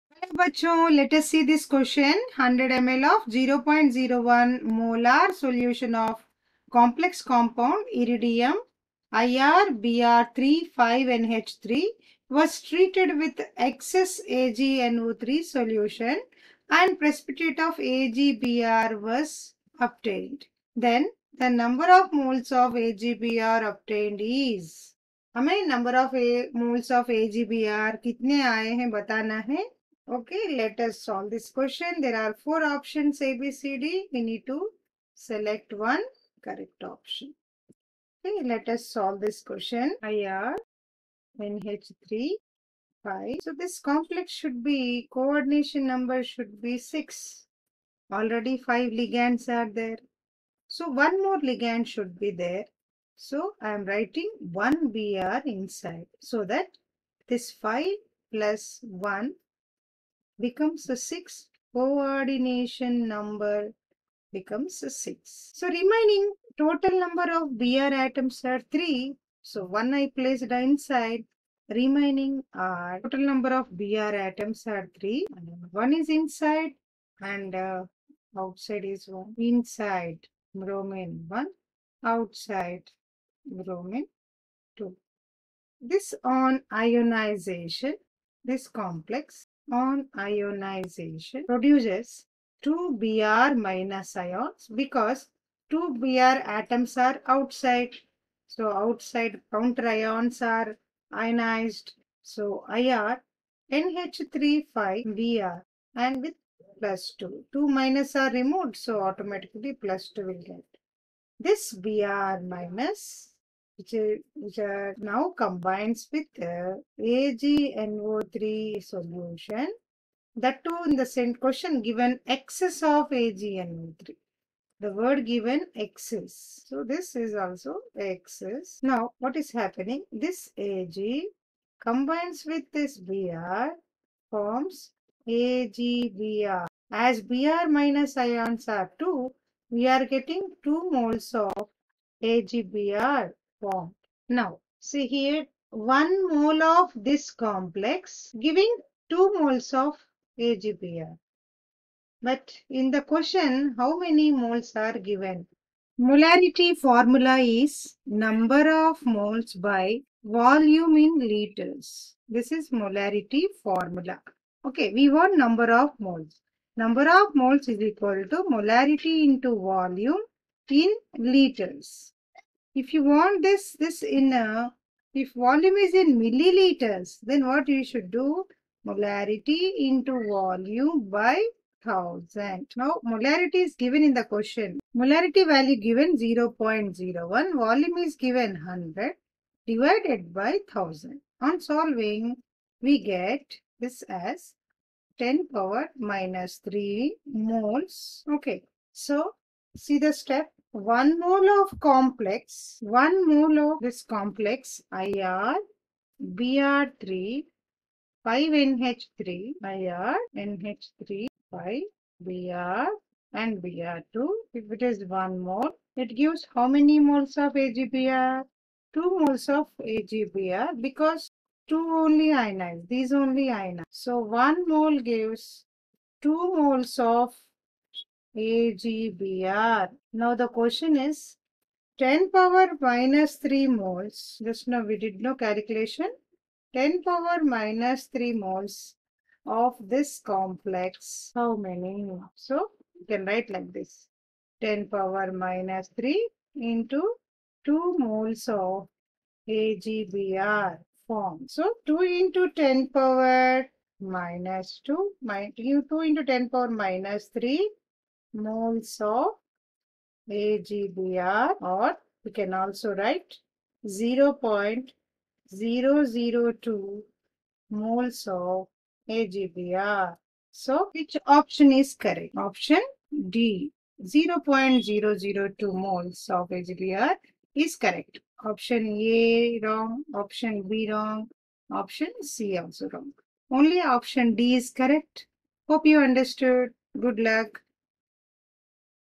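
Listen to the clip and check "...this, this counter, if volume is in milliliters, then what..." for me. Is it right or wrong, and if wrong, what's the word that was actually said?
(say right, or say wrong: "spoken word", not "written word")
wrong: "inner", not "counter".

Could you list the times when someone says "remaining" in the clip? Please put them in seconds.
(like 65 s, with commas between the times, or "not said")
65 s, 71 s.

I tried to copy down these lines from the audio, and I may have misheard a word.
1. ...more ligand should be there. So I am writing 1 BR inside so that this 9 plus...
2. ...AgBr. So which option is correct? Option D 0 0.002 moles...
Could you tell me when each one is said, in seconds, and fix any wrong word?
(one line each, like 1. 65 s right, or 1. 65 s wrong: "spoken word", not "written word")
1. 51 s wrong: "5", not "9"
2. 269 s right.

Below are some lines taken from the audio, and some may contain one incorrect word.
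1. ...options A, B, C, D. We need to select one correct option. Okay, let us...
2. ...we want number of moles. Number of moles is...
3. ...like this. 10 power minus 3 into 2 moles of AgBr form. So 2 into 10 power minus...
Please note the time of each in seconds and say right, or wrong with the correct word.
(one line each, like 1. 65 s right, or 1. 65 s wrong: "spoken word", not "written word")
1. 32 s right
2. 164 s right
3. 243 s right.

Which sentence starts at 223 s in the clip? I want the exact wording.
So 1 mole gives 2 moles of AgBr.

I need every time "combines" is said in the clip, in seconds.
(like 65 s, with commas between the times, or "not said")
115 s, 131 s.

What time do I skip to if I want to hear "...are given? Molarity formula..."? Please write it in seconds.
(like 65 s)
154 s.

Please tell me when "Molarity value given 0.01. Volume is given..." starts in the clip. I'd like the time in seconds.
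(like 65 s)
184 s.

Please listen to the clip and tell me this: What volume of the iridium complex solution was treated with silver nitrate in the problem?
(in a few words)
100 mL.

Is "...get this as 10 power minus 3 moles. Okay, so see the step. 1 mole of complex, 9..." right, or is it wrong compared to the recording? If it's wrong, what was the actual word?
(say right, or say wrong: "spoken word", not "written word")
wrong: "1", not "9".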